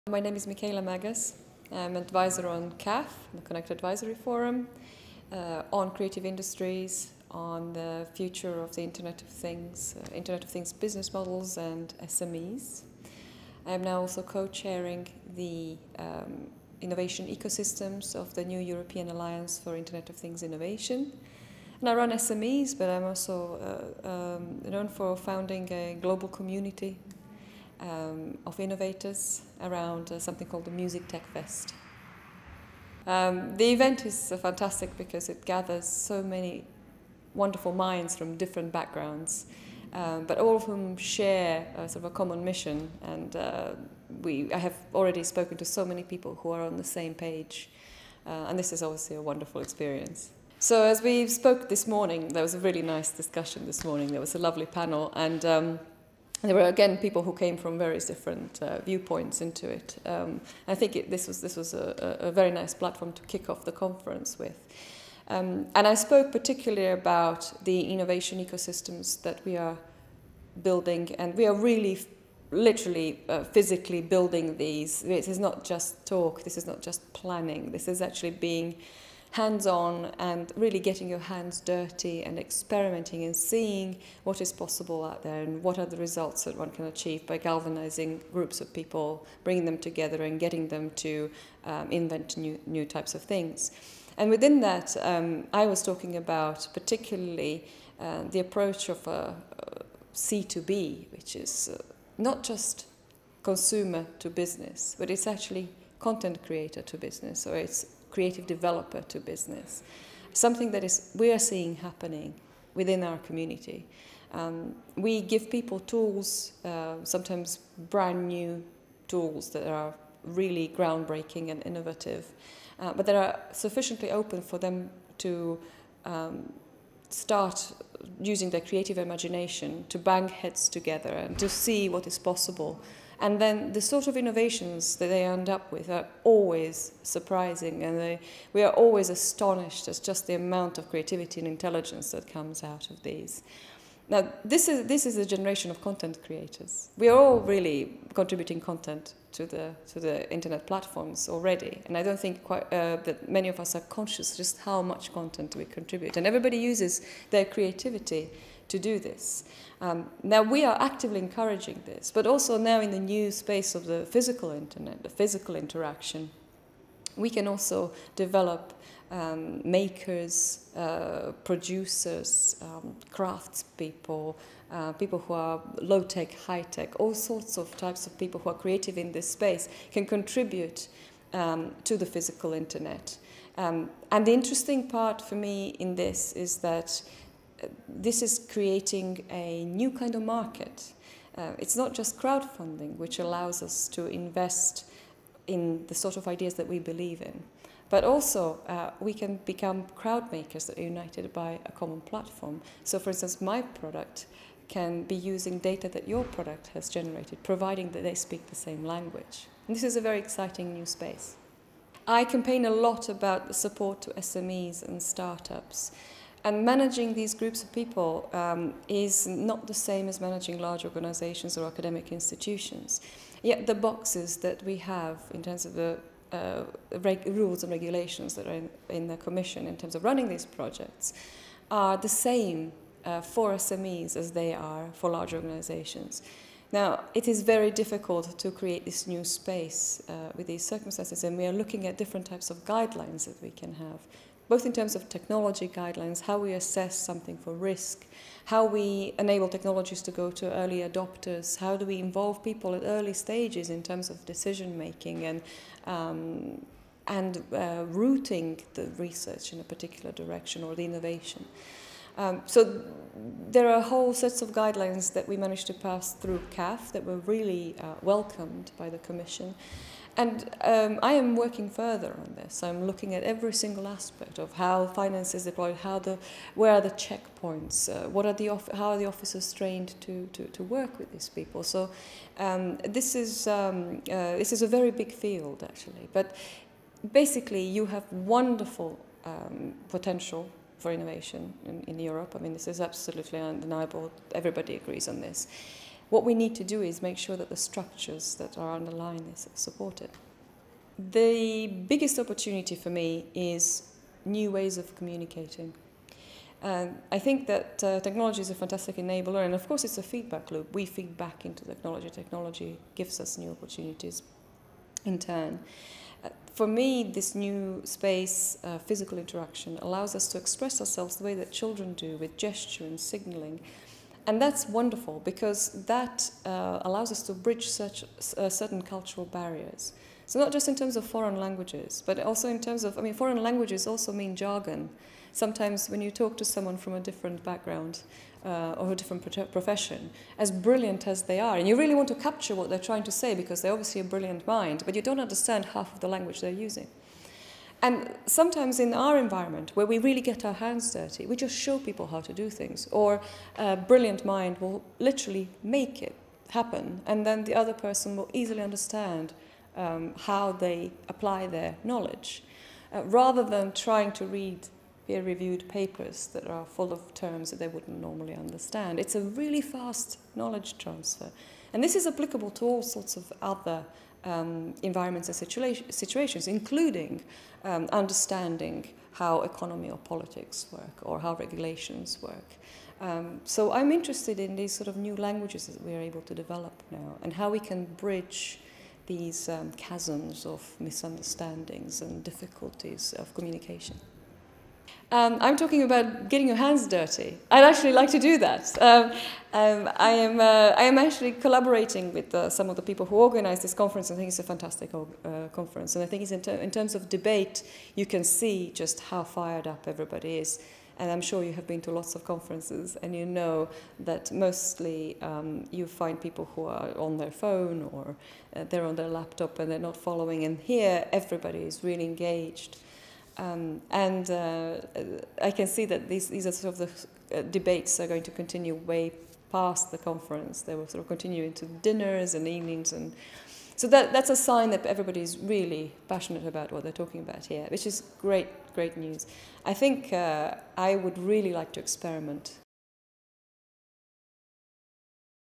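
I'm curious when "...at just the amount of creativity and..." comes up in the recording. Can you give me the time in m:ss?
2:19.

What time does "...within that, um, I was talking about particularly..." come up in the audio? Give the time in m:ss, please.
1:34.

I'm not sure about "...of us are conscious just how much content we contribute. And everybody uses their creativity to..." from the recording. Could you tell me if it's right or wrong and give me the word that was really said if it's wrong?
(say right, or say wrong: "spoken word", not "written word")
right.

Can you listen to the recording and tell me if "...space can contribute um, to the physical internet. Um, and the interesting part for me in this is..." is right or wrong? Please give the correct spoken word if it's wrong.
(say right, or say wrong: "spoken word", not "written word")
right.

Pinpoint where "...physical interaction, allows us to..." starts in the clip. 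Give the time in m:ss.
5:18.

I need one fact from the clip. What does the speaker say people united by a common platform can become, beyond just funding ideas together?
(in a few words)
crowd makers.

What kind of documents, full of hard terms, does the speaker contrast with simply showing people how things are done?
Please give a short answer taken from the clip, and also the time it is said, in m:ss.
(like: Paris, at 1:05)
peer-reviewed papers, at 6:05.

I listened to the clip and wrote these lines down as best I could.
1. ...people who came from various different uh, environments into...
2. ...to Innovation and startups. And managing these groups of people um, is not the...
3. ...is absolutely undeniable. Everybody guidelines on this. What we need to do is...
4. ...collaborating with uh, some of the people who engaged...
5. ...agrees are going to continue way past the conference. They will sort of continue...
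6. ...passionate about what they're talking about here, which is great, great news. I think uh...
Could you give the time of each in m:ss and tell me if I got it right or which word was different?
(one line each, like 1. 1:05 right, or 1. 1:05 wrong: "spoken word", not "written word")
1. 0:56 wrong: "viewpoints", not "environments"
2. 3:34 wrong: "SMEs", not "Innovation"
3. 4:52 wrong: "agrees", not "guidelines"
4. 6:41 wrong: "organized", not "engaged"
5. 7:07 wrong: "debates", not "agrees"
6. 7:16 right.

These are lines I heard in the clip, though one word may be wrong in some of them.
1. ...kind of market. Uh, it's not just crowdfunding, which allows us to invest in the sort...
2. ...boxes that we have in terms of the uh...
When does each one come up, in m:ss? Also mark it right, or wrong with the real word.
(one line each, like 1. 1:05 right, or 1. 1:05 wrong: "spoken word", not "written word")
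1. 3:09 right
2. 3:43 right.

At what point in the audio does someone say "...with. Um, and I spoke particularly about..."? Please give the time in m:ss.
1:04.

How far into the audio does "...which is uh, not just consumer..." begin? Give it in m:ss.
1:41.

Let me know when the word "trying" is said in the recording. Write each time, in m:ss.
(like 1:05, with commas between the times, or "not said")
5:42, 6:03.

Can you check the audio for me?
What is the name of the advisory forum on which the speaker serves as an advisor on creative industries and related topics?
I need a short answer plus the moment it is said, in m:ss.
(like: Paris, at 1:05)
Connect Advisory Forum, at 0:03.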